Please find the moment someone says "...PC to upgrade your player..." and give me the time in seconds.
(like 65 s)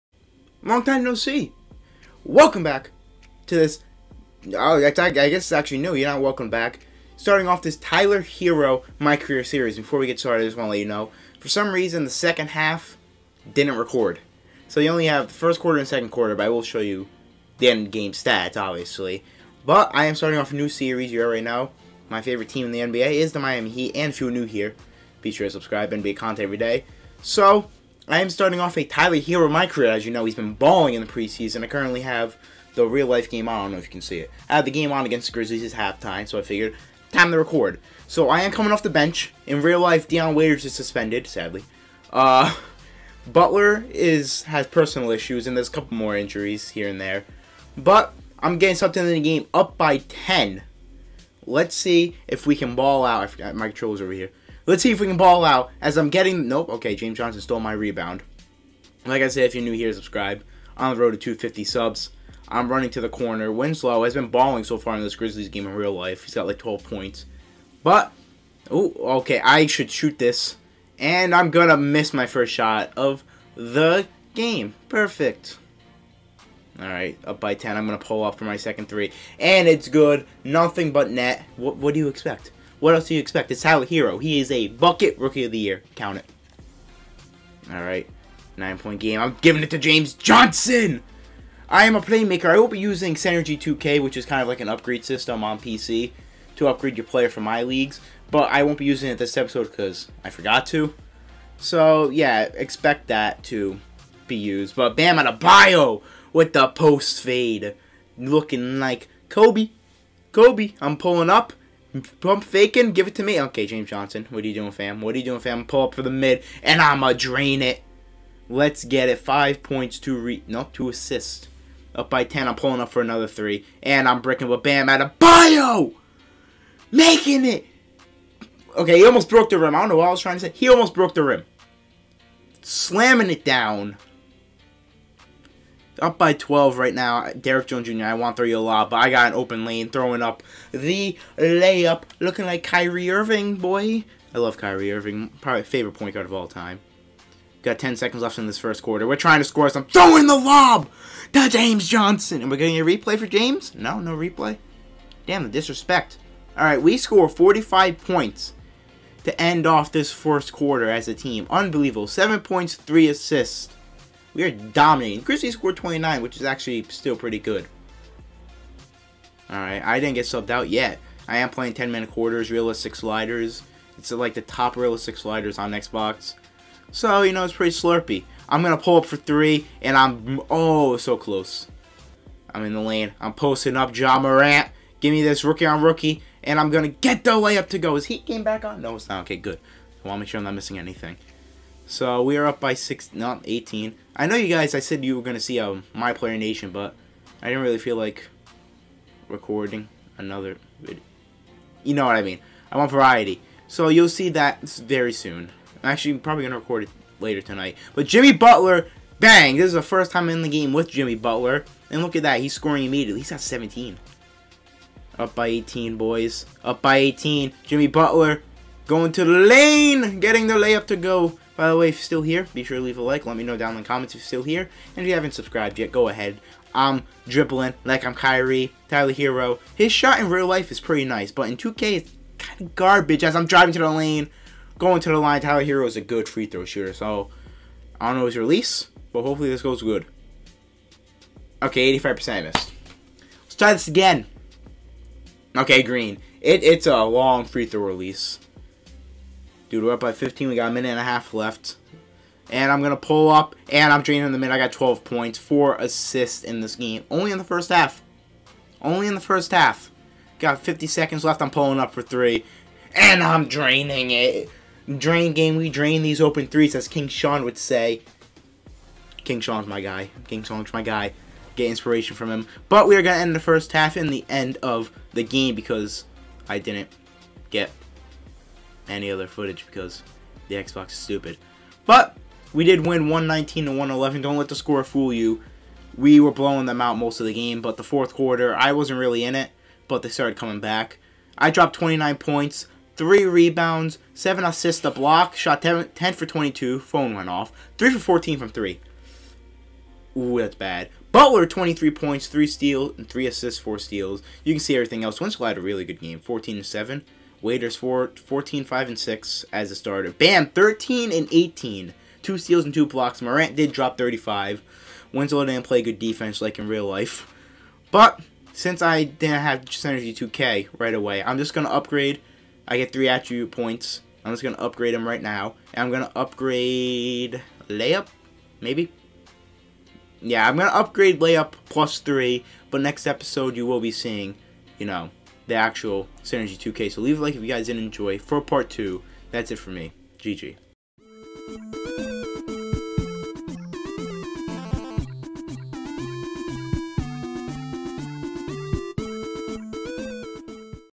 95 s.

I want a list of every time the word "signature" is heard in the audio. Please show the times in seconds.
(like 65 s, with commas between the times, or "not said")
not said.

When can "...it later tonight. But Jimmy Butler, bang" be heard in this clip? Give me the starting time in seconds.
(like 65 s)
206 s.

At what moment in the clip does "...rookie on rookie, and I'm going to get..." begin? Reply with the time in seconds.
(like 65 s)
185 s.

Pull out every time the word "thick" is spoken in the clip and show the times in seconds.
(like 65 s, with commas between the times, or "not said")
not said.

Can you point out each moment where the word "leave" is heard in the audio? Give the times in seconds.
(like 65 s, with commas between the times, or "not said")
222 s, 337 s.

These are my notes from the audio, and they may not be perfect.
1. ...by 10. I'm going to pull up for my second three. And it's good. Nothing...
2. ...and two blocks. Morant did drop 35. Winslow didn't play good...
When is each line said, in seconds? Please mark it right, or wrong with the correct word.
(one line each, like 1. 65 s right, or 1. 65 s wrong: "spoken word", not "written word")
1. 77 s right
2. 312 s right.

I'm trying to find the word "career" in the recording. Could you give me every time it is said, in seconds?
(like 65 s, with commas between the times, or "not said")
9 s, 29 s.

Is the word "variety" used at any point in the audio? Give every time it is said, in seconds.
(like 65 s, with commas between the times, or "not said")
202 s.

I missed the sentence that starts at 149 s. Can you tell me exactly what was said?
Throwing the lob to James Johnson.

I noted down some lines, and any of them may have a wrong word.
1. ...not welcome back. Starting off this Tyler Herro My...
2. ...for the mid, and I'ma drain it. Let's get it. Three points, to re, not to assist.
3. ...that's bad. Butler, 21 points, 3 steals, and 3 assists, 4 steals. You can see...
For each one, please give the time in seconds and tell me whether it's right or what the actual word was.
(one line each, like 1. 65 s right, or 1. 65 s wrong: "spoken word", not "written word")
1. 6 s right
2. 115 s wrong: "Five", not "Three"
3. 300 s wrong: "23", not "21".